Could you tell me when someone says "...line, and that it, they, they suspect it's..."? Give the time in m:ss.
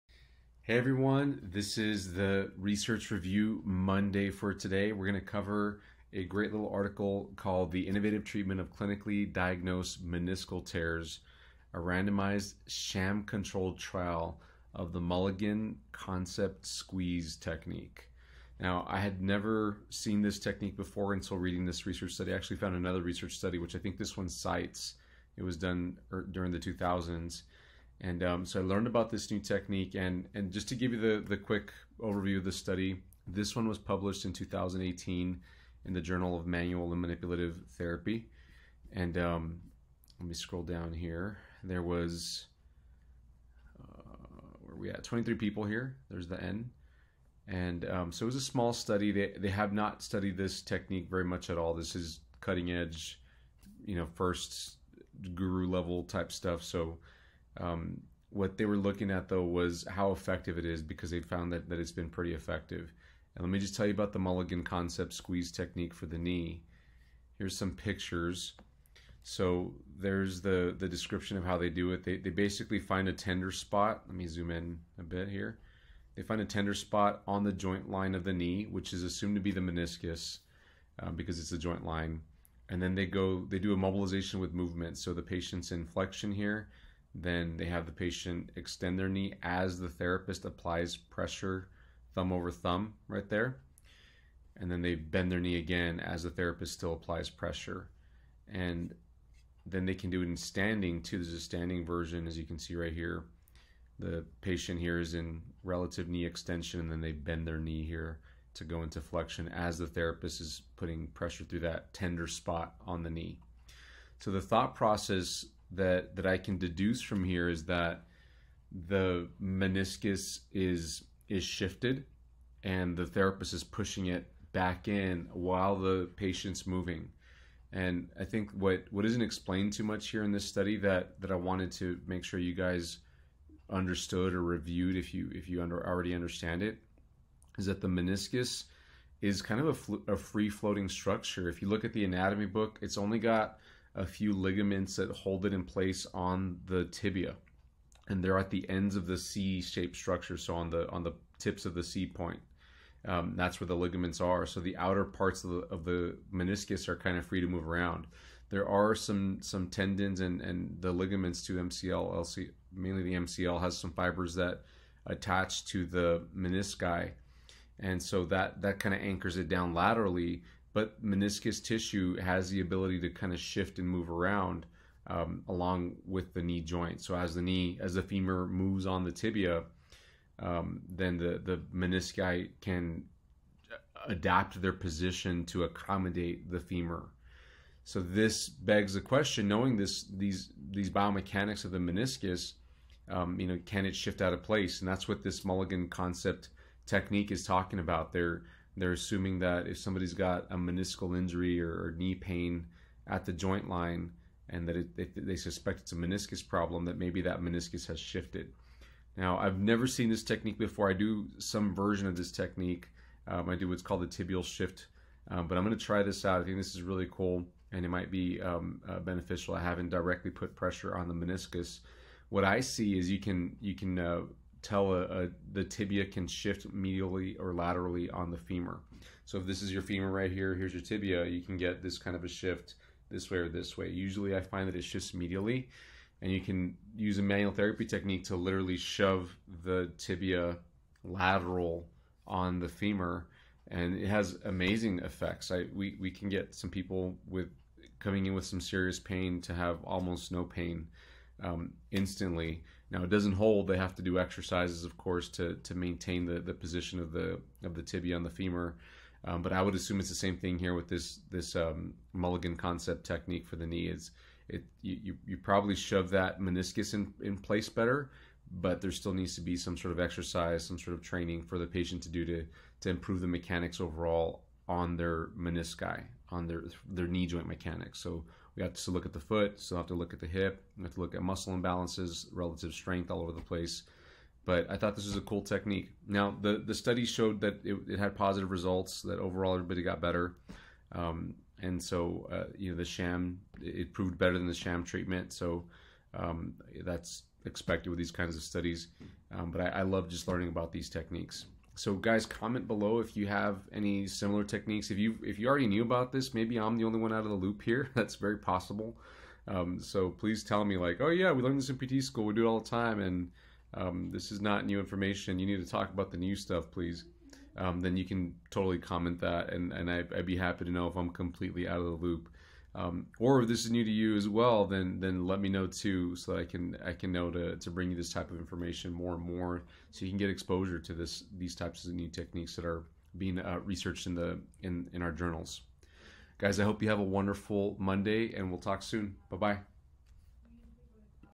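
3:23.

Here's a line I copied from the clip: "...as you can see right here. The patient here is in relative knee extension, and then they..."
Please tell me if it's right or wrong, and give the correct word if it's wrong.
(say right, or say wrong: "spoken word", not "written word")
right.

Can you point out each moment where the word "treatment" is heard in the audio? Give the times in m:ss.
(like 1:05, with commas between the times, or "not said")
0:08, 4:54.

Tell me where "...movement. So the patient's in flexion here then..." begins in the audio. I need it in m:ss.
1:24.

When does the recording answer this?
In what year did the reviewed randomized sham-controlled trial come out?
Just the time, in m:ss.
0:34.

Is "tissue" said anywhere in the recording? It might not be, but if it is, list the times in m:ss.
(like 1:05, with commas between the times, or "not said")
2:51.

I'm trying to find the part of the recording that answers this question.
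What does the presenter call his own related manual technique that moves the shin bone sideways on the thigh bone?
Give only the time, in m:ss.
3:34.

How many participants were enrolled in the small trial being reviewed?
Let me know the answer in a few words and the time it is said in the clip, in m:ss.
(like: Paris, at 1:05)
23, at 0:45.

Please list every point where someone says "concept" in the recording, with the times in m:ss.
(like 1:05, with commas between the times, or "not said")
0:15, 1:04, 3:15, 4:22.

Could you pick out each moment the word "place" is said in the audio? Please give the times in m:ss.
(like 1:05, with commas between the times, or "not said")
2:25, 3:14, 4:27, 4:43.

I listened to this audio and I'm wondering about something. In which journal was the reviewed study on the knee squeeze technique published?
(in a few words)
Journal of Manual and Manipulative Therapy.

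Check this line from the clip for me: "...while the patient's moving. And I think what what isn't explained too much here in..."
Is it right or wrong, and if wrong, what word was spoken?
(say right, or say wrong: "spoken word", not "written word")
right.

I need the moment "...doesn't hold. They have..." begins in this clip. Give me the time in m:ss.
4:13.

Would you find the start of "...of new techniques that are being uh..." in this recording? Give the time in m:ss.
5:31.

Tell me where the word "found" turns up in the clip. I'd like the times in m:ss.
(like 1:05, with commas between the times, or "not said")
0:22, 1:01.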